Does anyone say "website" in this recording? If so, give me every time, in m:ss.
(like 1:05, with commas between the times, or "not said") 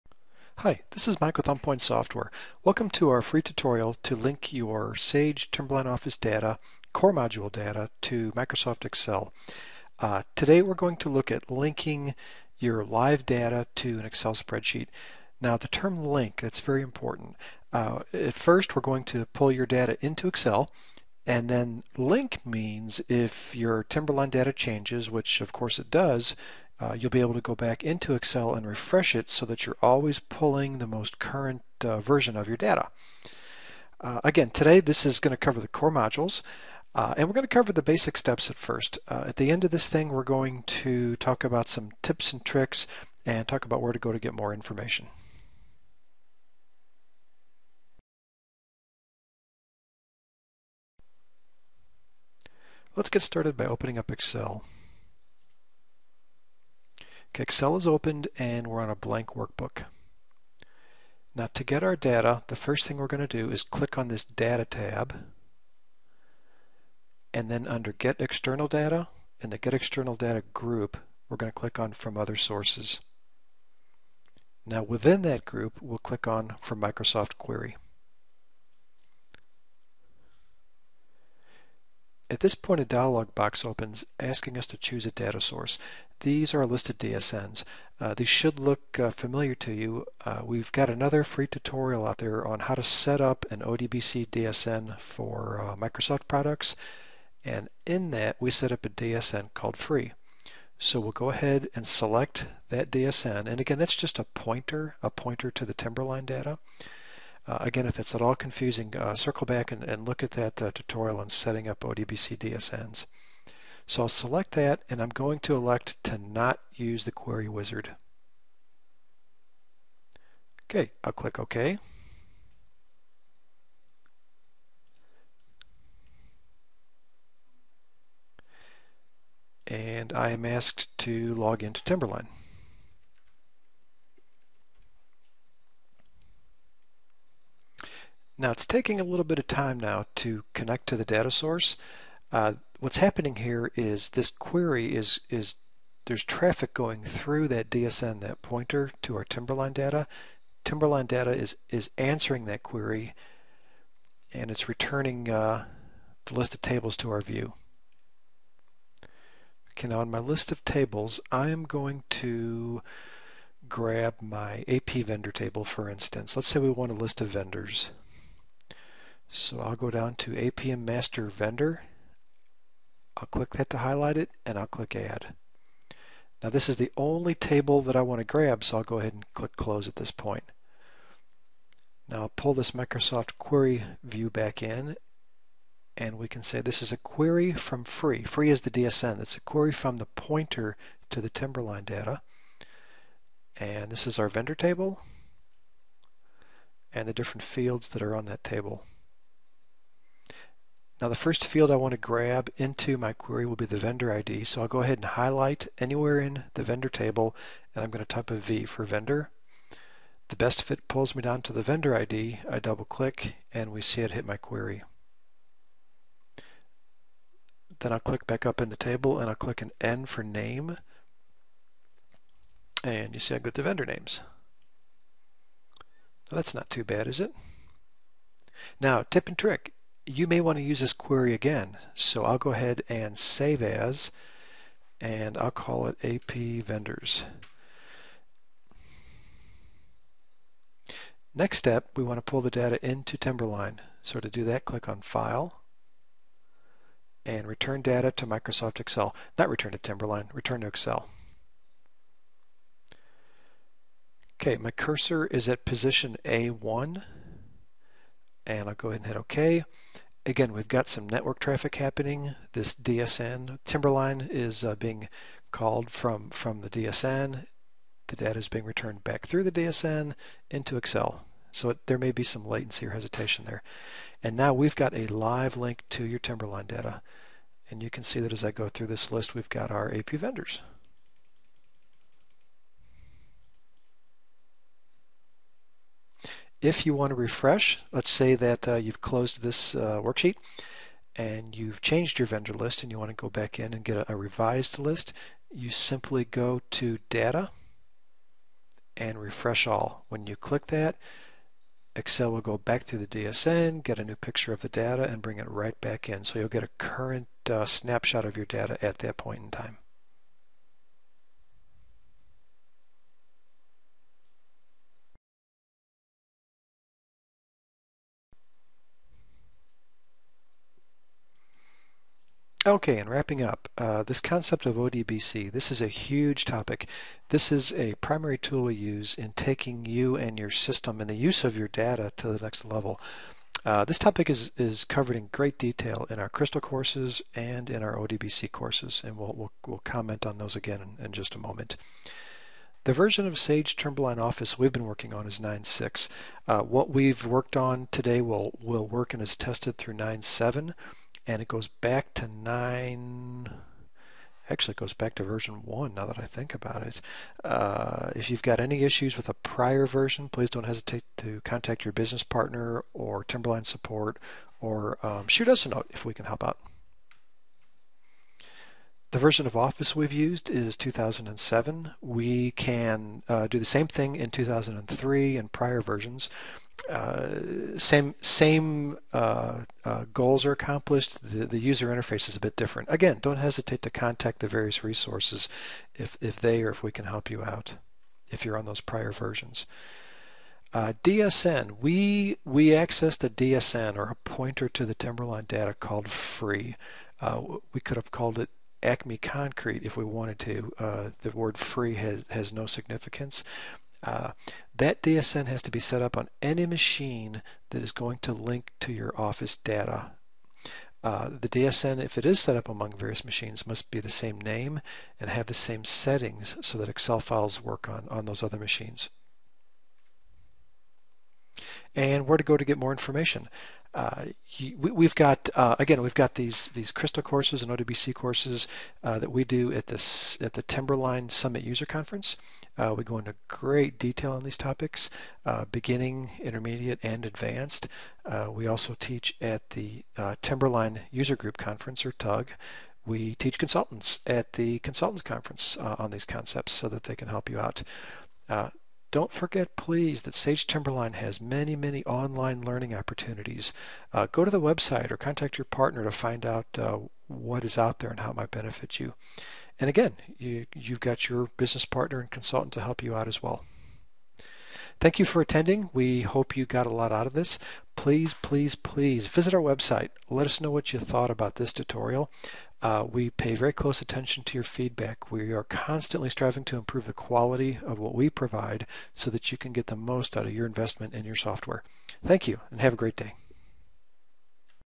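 7:34, 7:49.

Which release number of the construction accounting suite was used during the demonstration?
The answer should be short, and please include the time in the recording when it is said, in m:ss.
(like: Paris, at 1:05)
9.6, at 5:45.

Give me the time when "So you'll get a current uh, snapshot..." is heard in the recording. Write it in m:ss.
5:06.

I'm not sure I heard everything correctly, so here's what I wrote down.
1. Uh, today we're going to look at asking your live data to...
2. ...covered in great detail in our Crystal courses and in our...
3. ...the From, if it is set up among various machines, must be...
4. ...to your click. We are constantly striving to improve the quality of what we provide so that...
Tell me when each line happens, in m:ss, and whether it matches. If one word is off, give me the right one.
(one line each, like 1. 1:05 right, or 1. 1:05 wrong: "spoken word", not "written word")
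1. 0:09 wrong: "linking", not "asking"
2. 5:34 right
3. 6:51 wrong: "DSN", not "From"
4. 7:54 wrong: "feedback", not "click".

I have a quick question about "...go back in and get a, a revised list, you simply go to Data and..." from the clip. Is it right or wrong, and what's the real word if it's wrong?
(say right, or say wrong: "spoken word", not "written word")
right.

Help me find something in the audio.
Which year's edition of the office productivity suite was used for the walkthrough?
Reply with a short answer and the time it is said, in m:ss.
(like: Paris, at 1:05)
2007, at 6:10.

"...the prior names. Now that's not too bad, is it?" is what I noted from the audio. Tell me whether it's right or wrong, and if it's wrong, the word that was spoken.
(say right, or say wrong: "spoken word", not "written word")
wrong: "vendor", not "prior".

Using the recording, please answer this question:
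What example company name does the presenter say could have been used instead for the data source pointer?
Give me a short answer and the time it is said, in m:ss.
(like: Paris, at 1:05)
Acme Concrete, at 6:38.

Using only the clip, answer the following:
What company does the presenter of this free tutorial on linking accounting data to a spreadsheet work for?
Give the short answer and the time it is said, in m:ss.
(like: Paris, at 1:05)
OnPoint Software, at 0:01.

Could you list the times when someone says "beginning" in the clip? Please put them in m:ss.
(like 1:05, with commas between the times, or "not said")
7:15.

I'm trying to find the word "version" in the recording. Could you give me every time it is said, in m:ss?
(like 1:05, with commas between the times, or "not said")
0:31, 5:42, 5:55, 5:59, 6:09, 6:15, 6:29.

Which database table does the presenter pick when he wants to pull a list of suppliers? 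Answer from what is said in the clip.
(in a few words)
APM Master Vendor.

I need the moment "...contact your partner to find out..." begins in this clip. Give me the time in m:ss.
7:35.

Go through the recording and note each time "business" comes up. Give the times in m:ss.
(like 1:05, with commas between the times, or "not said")
6:01, 7:41.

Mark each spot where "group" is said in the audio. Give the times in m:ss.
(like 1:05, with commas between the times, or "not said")
1:10, 1:15, 7:21.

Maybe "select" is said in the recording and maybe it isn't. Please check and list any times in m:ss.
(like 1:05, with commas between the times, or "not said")
1:41, 1:54.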